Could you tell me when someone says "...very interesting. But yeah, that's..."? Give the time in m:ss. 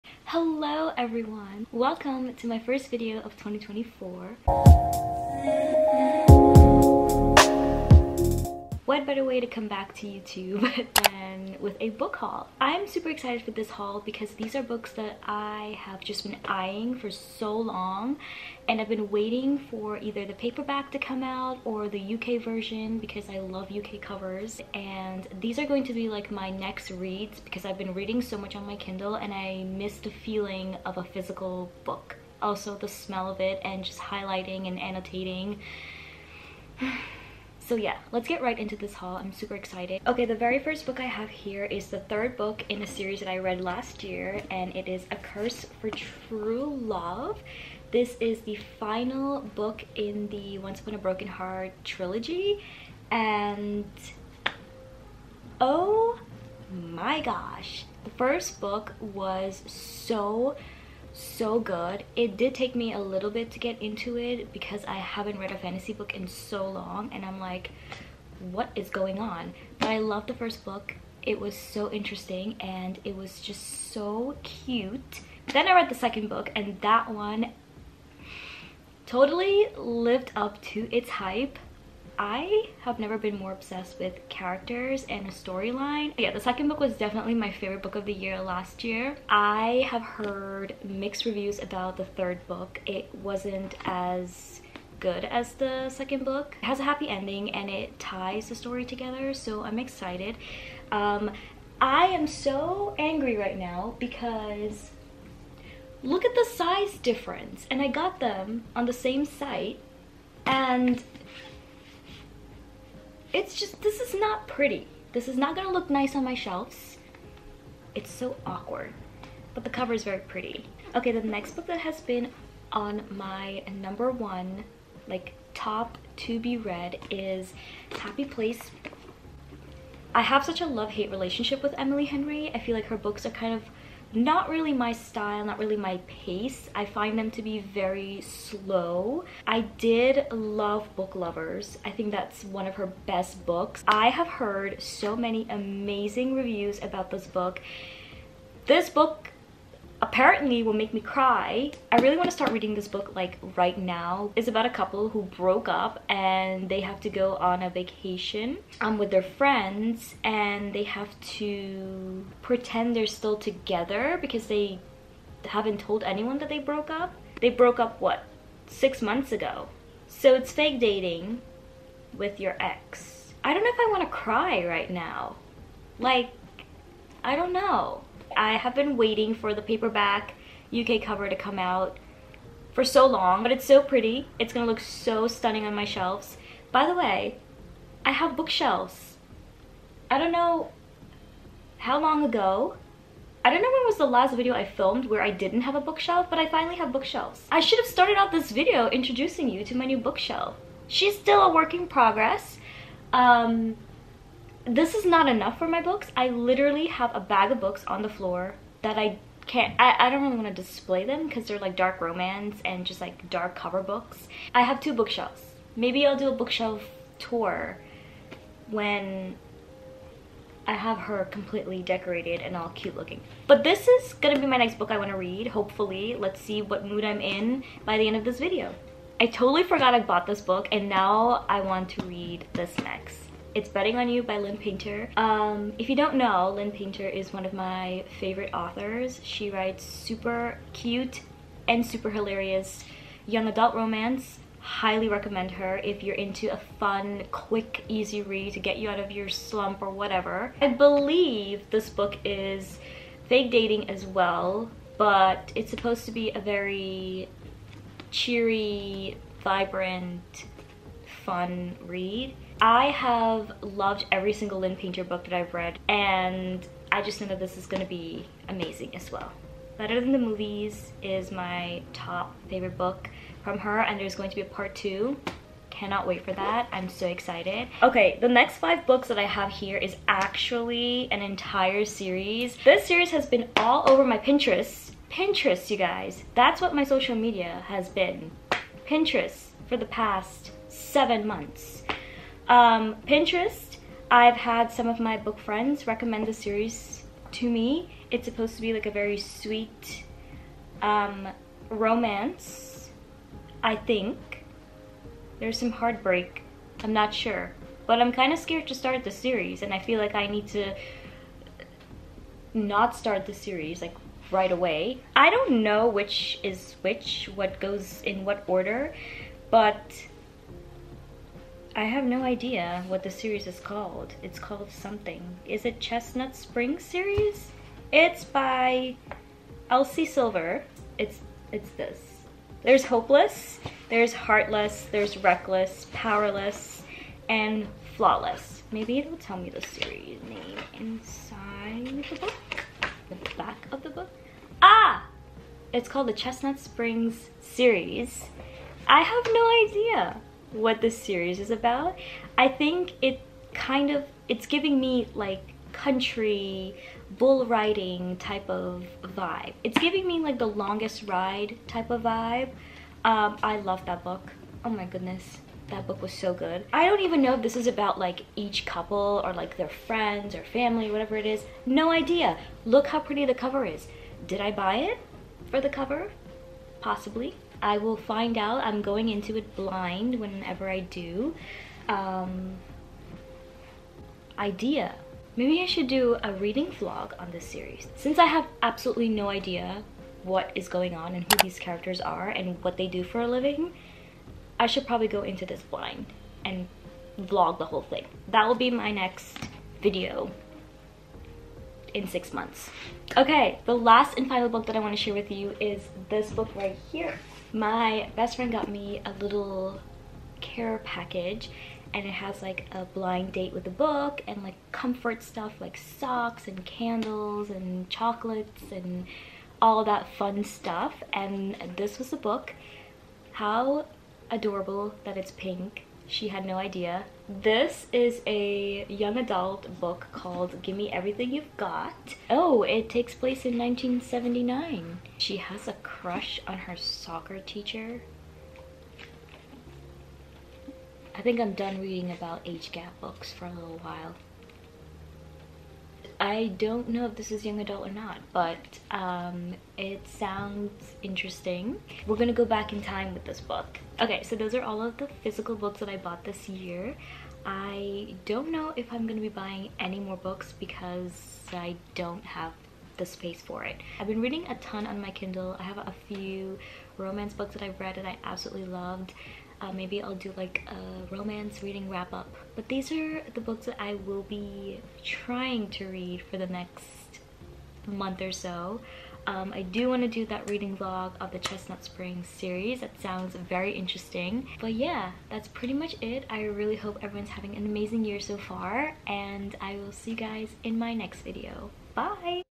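8:03.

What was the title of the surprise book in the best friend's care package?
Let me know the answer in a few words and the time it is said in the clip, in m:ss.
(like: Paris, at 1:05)
Gimme Everything You've Got, at 7:10.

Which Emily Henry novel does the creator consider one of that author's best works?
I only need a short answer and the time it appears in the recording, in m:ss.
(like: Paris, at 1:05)
Book Lovers, at 2:20.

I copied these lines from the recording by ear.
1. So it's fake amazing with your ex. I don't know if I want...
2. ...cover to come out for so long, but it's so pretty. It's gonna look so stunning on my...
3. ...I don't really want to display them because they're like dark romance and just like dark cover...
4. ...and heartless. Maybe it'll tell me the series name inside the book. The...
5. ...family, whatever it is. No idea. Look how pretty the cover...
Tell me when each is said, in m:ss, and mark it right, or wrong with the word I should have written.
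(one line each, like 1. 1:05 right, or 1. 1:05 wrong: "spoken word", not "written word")
1. 2:50 wrong: "dating", not "amazing"
2. 3:01 right
3. 3:29 right
4. 5:37 wrong: "flawless", not "heartless"
5. 6:10 right.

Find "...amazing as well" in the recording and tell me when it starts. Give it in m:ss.
4:28.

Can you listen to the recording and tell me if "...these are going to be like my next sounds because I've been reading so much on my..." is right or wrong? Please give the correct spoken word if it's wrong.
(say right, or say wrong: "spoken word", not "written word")
wrong: "reads", not "sounds".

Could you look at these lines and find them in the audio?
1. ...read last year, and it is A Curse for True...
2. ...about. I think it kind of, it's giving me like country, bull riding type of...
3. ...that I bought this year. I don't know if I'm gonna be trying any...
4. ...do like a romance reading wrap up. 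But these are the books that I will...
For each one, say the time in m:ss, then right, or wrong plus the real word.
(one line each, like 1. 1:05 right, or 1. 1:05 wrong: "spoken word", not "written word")
1. 0:43 right
2. 5:51 right
3. 7:35 wrong: "buying", not "trying"
4. 7:50 right.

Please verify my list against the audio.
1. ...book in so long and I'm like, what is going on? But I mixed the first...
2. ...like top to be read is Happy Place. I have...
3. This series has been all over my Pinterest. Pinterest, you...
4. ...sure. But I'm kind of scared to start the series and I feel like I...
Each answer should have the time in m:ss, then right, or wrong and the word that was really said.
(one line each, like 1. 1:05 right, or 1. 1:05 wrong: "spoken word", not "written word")
1. 1:05 wrong: "loved", not "mixed"
2. 2:05 right
3. 4:42 right
4. 5:07 right.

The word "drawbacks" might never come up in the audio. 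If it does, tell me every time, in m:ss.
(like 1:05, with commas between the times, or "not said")
not said.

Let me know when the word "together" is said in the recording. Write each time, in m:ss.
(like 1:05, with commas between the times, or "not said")
1:38, 2:43.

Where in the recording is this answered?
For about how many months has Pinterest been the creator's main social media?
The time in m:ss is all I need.
4:50.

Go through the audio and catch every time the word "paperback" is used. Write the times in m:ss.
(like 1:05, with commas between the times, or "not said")
0:20, 2:59.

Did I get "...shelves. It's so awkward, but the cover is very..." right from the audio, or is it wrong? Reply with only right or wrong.
right.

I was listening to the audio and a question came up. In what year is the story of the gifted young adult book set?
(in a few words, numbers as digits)
1979.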